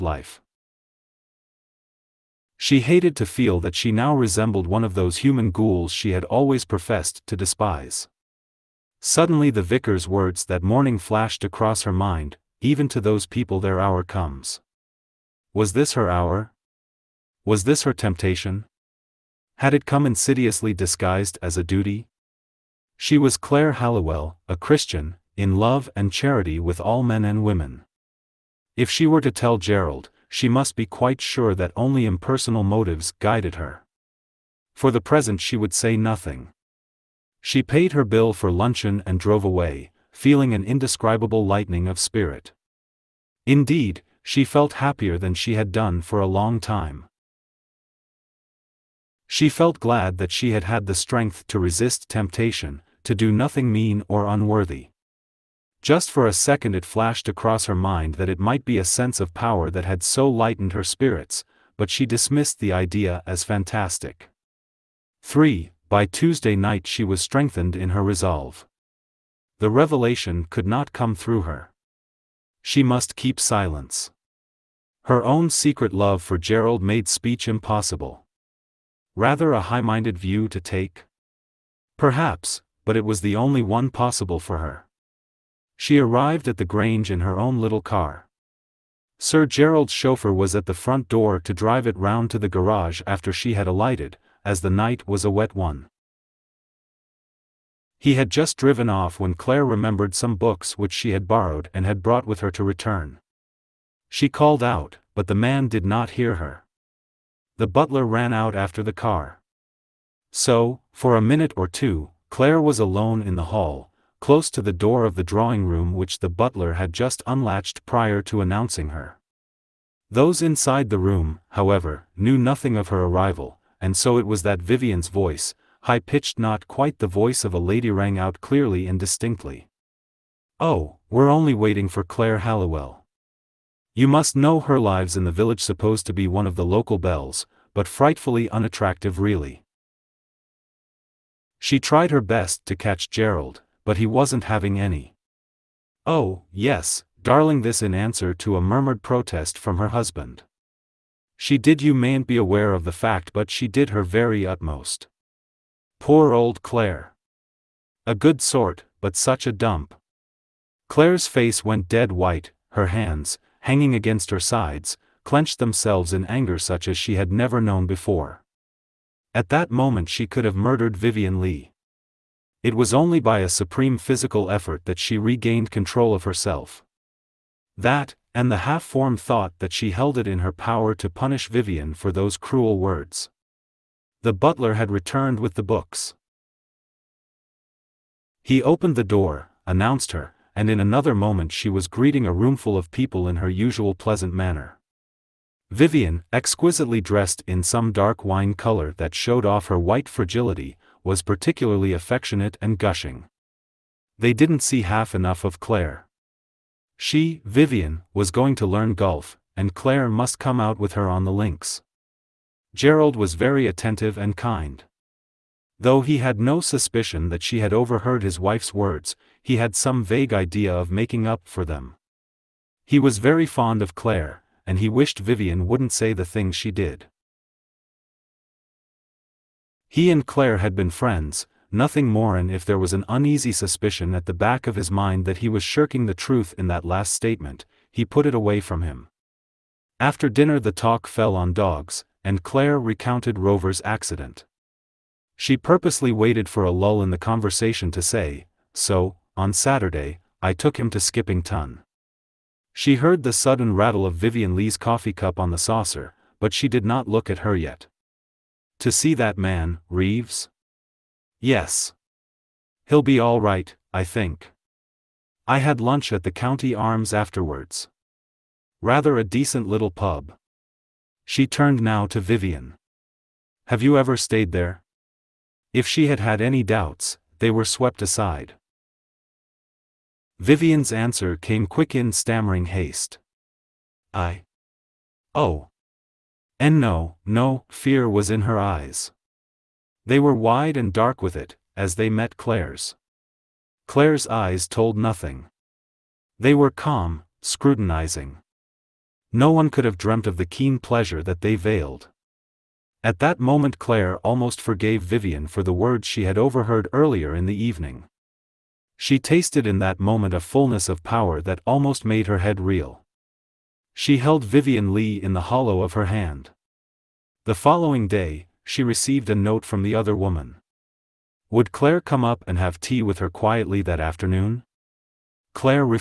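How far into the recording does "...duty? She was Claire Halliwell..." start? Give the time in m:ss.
0:21.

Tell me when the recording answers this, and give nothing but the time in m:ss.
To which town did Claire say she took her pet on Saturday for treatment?
4:10.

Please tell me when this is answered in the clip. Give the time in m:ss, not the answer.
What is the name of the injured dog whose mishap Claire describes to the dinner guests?
4:03.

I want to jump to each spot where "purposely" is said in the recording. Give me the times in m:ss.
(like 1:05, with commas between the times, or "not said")
4:05.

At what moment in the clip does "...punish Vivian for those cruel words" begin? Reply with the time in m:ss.
3:01.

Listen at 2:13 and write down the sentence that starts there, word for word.
You must know her lives in the village supposed to be one of the local belles, but frightfully unattractive really.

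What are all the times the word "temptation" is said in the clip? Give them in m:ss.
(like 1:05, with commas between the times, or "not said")
0:17, 0:52.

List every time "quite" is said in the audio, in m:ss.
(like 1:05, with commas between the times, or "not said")
0:30, 2:06.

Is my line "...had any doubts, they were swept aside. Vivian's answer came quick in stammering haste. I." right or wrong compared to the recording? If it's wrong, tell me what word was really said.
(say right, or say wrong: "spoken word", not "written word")
right.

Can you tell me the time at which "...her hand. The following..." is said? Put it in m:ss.
5:15.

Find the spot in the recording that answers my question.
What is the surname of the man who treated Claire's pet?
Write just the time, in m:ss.
4:19.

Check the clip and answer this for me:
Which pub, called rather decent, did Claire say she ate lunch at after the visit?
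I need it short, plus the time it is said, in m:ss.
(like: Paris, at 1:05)
the County Arms, at 4:26.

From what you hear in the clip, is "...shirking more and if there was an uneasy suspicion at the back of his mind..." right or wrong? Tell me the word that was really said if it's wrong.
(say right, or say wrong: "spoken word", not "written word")
wrong: "nothing", not "shirking".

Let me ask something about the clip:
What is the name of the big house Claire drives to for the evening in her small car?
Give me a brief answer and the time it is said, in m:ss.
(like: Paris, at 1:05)
the Grange, at 1:26.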